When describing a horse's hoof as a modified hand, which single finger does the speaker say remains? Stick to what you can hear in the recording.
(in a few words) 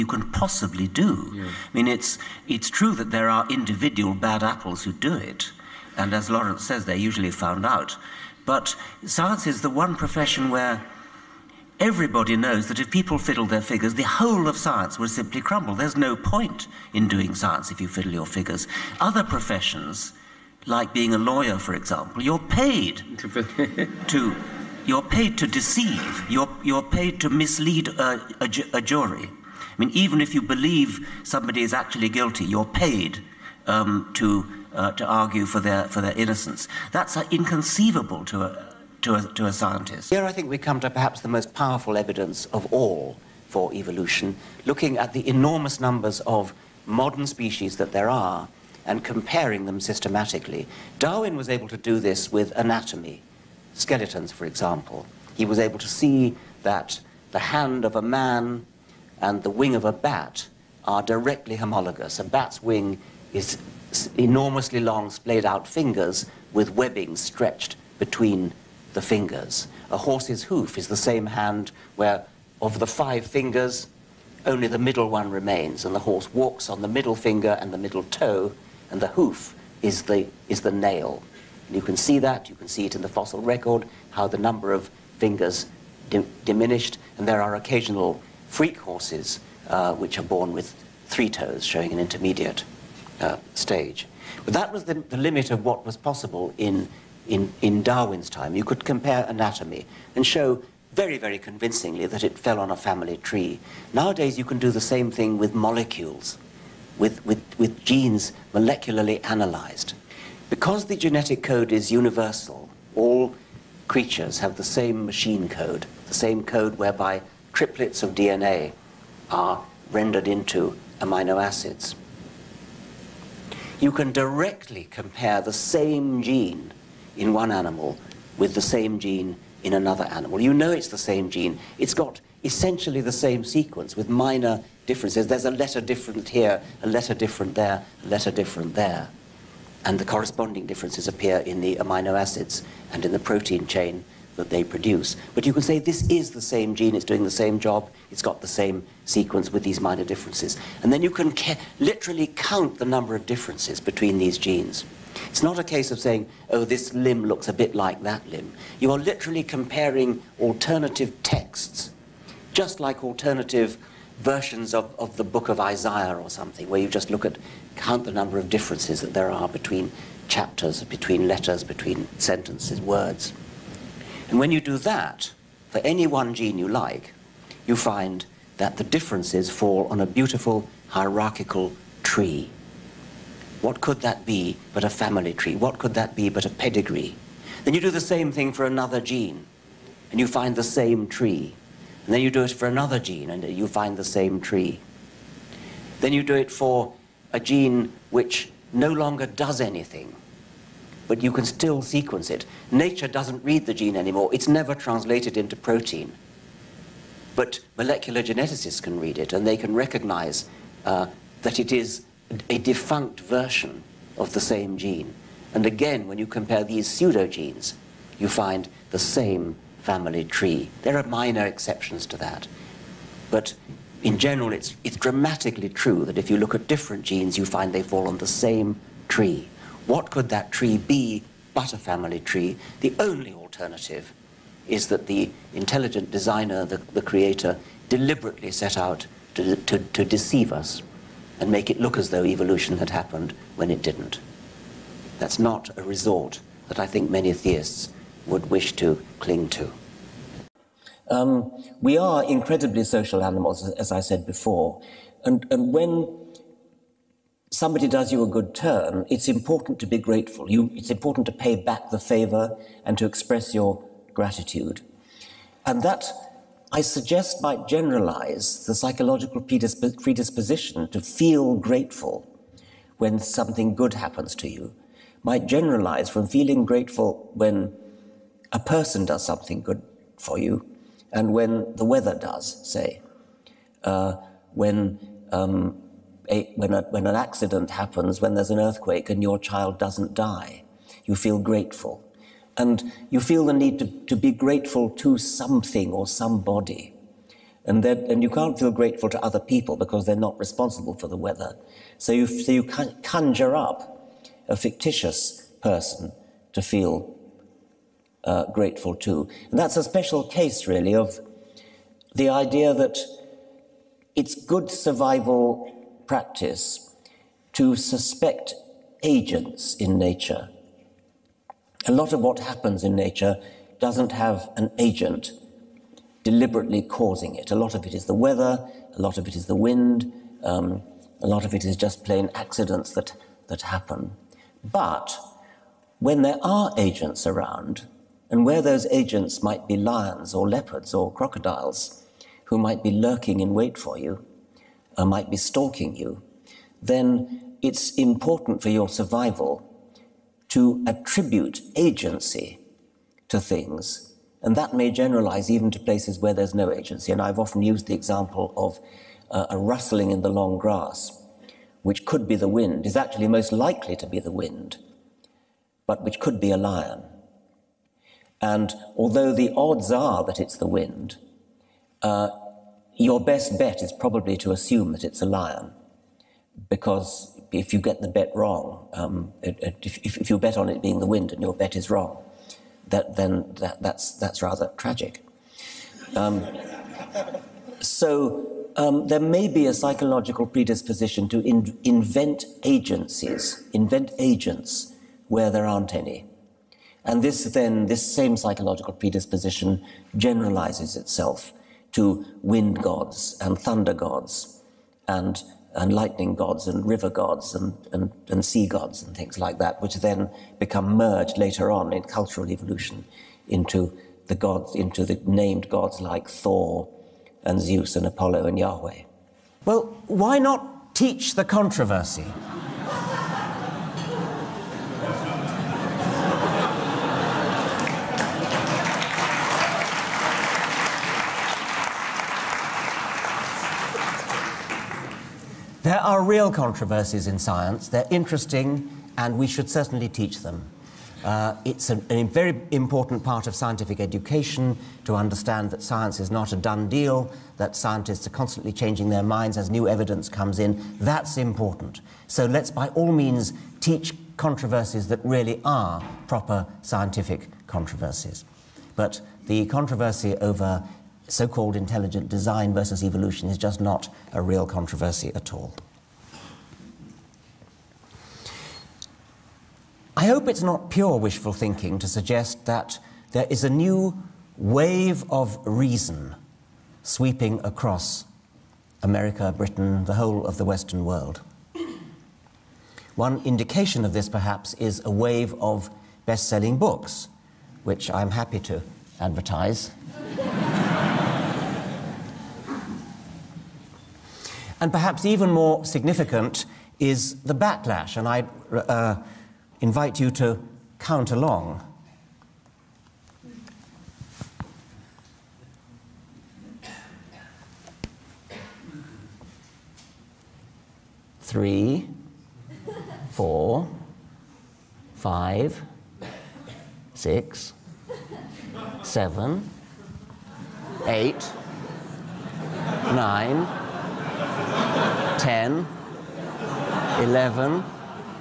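The middle one.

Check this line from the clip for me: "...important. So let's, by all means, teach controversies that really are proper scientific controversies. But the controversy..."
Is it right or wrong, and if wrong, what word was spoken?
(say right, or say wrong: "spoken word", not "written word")
right.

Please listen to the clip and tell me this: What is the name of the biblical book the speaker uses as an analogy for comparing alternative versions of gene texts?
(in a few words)
Isaiah.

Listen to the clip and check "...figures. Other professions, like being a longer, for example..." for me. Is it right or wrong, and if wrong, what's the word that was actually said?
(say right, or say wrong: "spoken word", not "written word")
wrong: "lawyer", not "longer".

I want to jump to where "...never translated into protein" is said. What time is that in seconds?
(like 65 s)
204 s.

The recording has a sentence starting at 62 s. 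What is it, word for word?
A bat's wing is enormously long splayed out fingers with webbing stretched between the fingers.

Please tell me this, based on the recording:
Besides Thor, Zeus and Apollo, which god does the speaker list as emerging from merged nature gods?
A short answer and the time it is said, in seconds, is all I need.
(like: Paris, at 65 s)
Yahweh, at 418 s.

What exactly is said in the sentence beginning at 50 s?
Darwin was able to do this with anatomy, skeletons, for example.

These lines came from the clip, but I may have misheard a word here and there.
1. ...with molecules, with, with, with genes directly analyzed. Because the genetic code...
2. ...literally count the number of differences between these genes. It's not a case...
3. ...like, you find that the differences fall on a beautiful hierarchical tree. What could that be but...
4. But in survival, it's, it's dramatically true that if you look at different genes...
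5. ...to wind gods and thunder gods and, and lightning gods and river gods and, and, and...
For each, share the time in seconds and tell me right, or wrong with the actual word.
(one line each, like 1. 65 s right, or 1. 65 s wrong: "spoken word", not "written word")
1. 105 s wrong: "molecularly", not "directly"
2. 151 s right
3. 176 s right
4. 223 s wrong: "general", not "survival"
5. 401 s right.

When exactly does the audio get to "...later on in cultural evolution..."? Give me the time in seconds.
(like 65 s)
411 s.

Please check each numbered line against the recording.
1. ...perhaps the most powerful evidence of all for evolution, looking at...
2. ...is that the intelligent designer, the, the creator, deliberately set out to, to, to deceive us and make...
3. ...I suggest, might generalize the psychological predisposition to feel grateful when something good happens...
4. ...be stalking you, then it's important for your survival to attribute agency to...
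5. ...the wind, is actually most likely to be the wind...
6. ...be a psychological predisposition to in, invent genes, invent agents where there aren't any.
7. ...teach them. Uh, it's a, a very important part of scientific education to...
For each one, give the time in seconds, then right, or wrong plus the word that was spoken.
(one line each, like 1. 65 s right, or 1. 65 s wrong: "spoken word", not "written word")
1. 40 s right
2. 234 s right
3. 266 s right
4. 345 s right
5. 362 s right
6. 389 s wrong: "agencies", not "genes"
7. 440 s right.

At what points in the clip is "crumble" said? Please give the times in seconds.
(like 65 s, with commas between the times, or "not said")
15 s.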